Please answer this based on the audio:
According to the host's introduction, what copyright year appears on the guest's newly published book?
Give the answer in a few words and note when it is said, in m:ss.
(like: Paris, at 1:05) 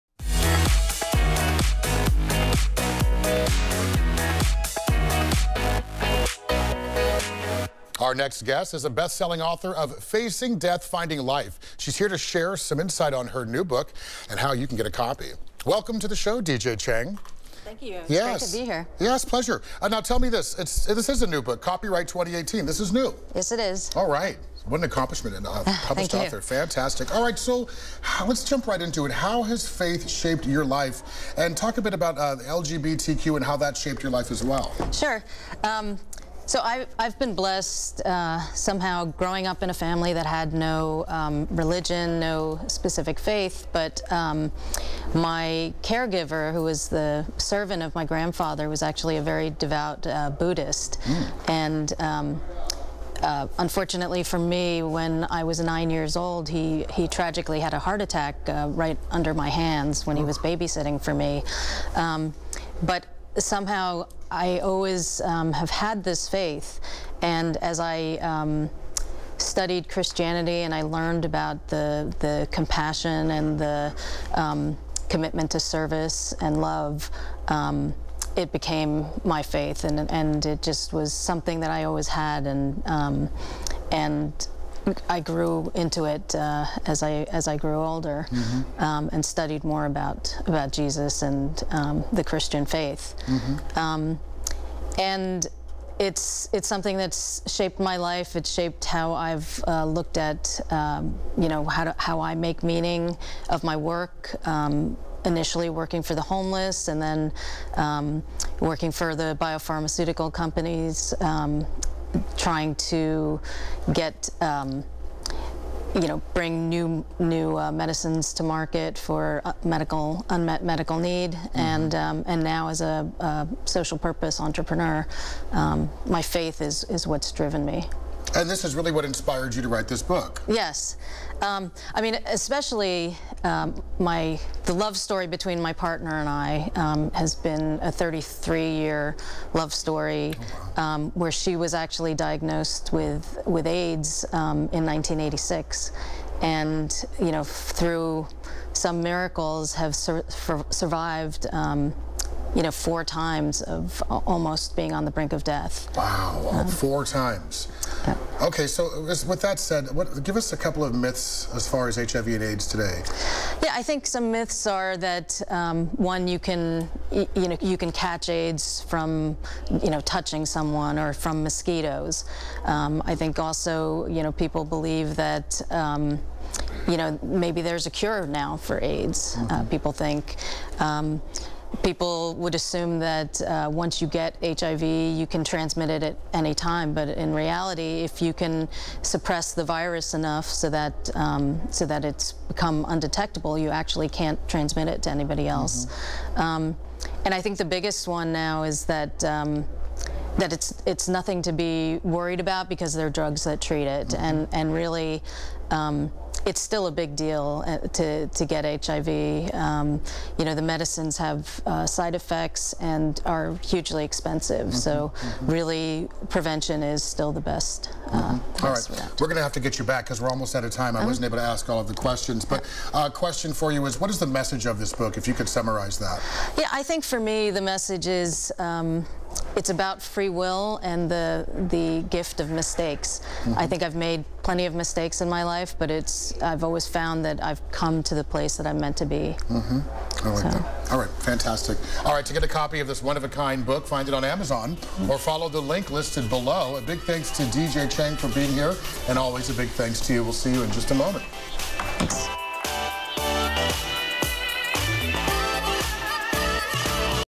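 2018, at 0:22.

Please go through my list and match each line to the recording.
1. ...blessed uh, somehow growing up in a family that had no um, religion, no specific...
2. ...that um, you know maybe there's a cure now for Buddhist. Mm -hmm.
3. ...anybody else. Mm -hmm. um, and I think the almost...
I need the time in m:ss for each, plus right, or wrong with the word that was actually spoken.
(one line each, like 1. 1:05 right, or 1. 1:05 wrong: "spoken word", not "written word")
1. 0:37 right
2. 2:55 wrong: "AIDS", not "Buddhist"
3. 3:15 wrong: "biggest", not "almost".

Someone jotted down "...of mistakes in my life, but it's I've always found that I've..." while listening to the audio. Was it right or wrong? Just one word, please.
right.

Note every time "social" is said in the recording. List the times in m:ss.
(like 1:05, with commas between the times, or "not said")
2:03.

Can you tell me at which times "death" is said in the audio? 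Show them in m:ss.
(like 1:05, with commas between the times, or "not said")
0:10, 2:35.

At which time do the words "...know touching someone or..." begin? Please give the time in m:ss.
2:49.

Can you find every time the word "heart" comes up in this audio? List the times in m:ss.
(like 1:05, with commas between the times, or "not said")
0:57.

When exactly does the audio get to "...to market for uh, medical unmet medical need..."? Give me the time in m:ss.
1:58.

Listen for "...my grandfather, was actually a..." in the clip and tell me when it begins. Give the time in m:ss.
0:47.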